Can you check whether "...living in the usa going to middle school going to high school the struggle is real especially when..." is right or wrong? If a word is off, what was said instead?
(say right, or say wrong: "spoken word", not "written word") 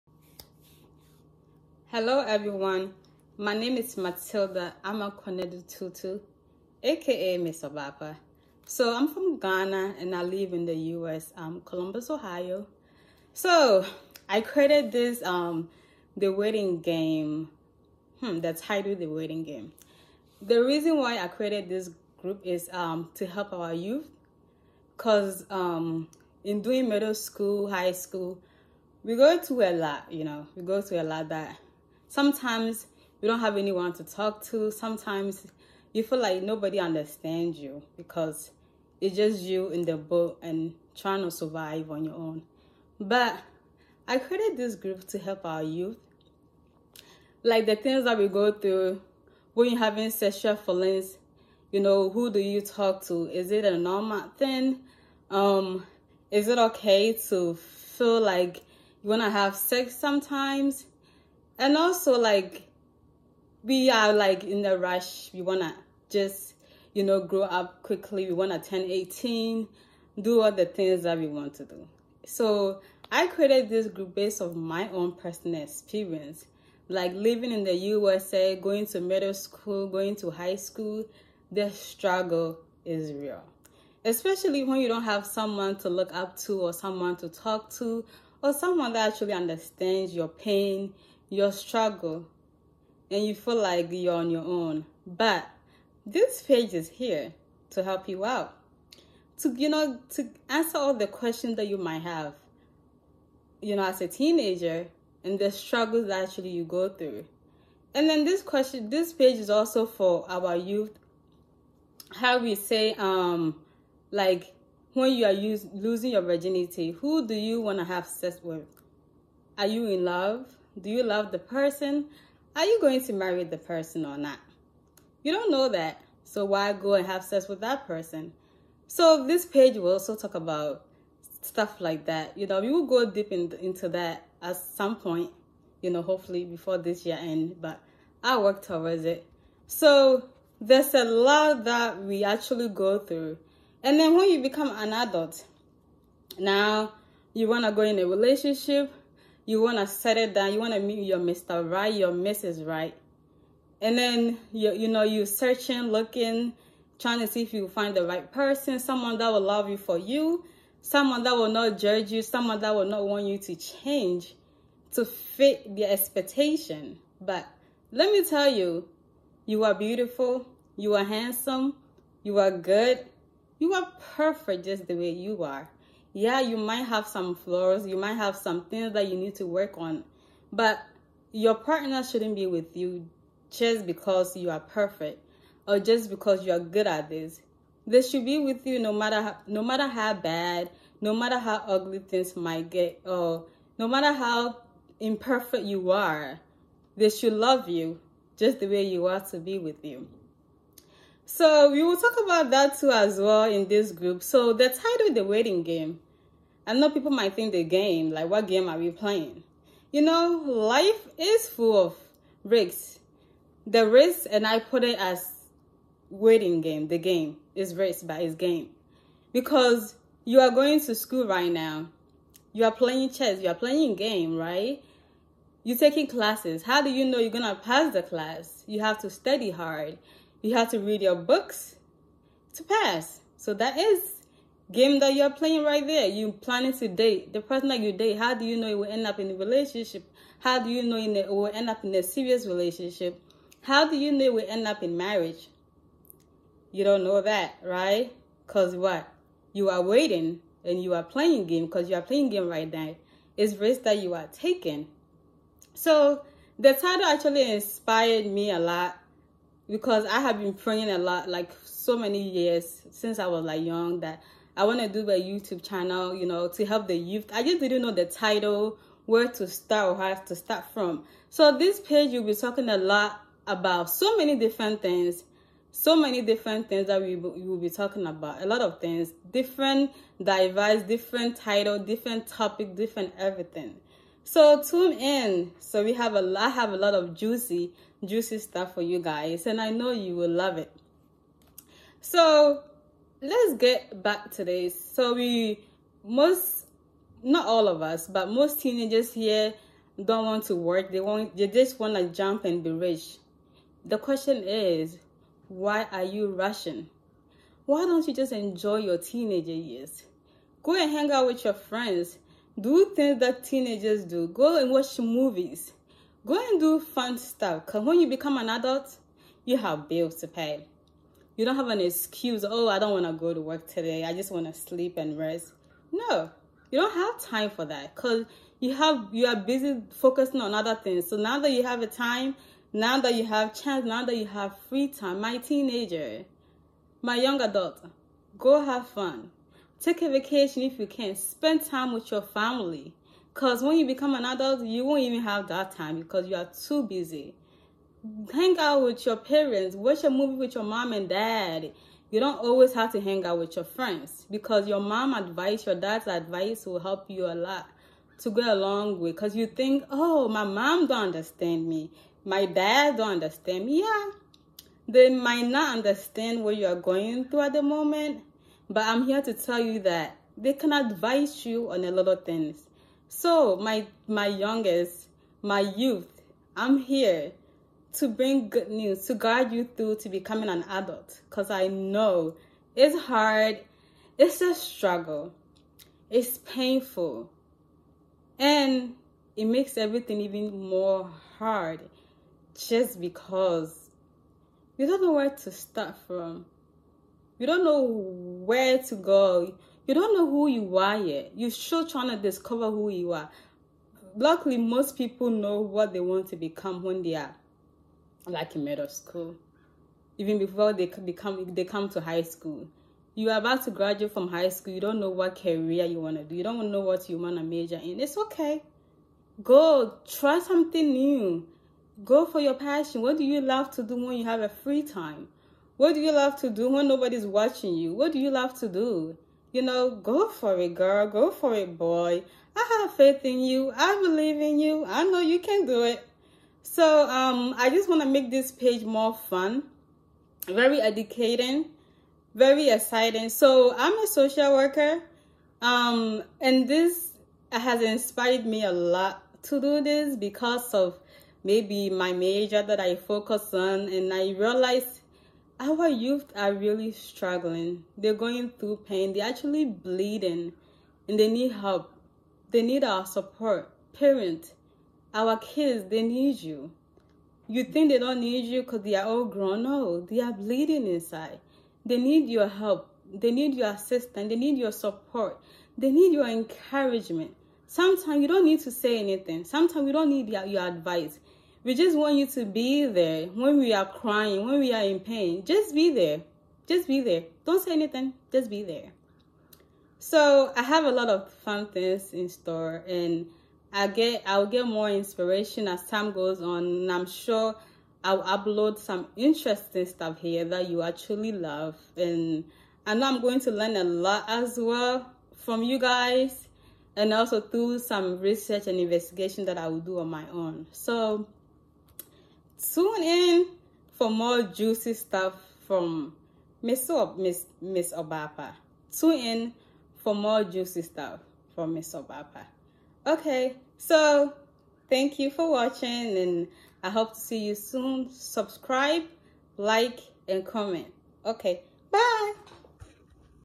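right.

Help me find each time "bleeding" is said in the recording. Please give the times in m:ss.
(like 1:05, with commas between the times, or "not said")
7:39, 7:50.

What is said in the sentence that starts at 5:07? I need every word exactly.
Why don't you just enjoy your teenager years?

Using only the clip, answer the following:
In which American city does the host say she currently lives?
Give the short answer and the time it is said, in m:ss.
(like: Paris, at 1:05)
Columbus, Ohio, at 0:11.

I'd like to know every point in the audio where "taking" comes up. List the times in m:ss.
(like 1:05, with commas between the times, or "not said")
3:45, 4:14.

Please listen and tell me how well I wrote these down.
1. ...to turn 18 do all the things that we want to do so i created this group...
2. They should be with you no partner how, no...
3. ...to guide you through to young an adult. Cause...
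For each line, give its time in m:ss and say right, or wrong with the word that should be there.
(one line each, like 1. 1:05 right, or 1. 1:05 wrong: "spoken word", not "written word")
1. 1:08 right
2. 3:07 wrong: "matter", not "partner"
3. 6:19 wrong: "becoming", not "young".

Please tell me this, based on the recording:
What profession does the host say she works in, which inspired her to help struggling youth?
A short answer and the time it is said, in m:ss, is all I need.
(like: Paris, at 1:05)
Social worker, at 7:24.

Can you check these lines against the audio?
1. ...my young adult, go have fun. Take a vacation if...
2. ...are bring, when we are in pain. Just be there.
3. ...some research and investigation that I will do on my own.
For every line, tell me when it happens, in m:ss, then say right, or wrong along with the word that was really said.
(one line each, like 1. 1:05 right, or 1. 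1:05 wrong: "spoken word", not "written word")
1. 5:37 right
2. 8:03 wrong: "crying", not "bring"
3. 8:27 right.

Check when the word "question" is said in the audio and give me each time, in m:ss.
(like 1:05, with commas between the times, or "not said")
1:41, 1:48, 5:03.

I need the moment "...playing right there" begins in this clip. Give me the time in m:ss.
3:55.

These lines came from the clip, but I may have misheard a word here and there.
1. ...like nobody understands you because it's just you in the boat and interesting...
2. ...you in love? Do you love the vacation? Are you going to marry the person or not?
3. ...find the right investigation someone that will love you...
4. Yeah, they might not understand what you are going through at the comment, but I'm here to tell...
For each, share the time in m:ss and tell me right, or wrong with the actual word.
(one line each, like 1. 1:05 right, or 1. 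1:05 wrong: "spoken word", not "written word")
1. 0:36 wrong: "trying", not "interesting"
2. 1:59 wrong: "person", not "vacation"
3. 2:37 wrong: "person", not "investigation"
4. 6:03 wrong: "moment", not "comment".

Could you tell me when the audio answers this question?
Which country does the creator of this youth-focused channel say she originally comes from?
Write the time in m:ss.
0:09.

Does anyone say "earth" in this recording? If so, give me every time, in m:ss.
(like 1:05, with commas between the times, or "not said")
not said.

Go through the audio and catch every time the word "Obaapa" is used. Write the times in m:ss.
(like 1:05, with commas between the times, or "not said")
0:07, 8:37, 8:41.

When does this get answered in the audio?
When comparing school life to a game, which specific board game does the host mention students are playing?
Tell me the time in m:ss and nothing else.
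3:43.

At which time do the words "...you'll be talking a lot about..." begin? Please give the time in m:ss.
4:32.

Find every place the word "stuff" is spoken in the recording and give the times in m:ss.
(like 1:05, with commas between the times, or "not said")
2:11, 4:48, 5:17, 8:19, 8:34, 8:40.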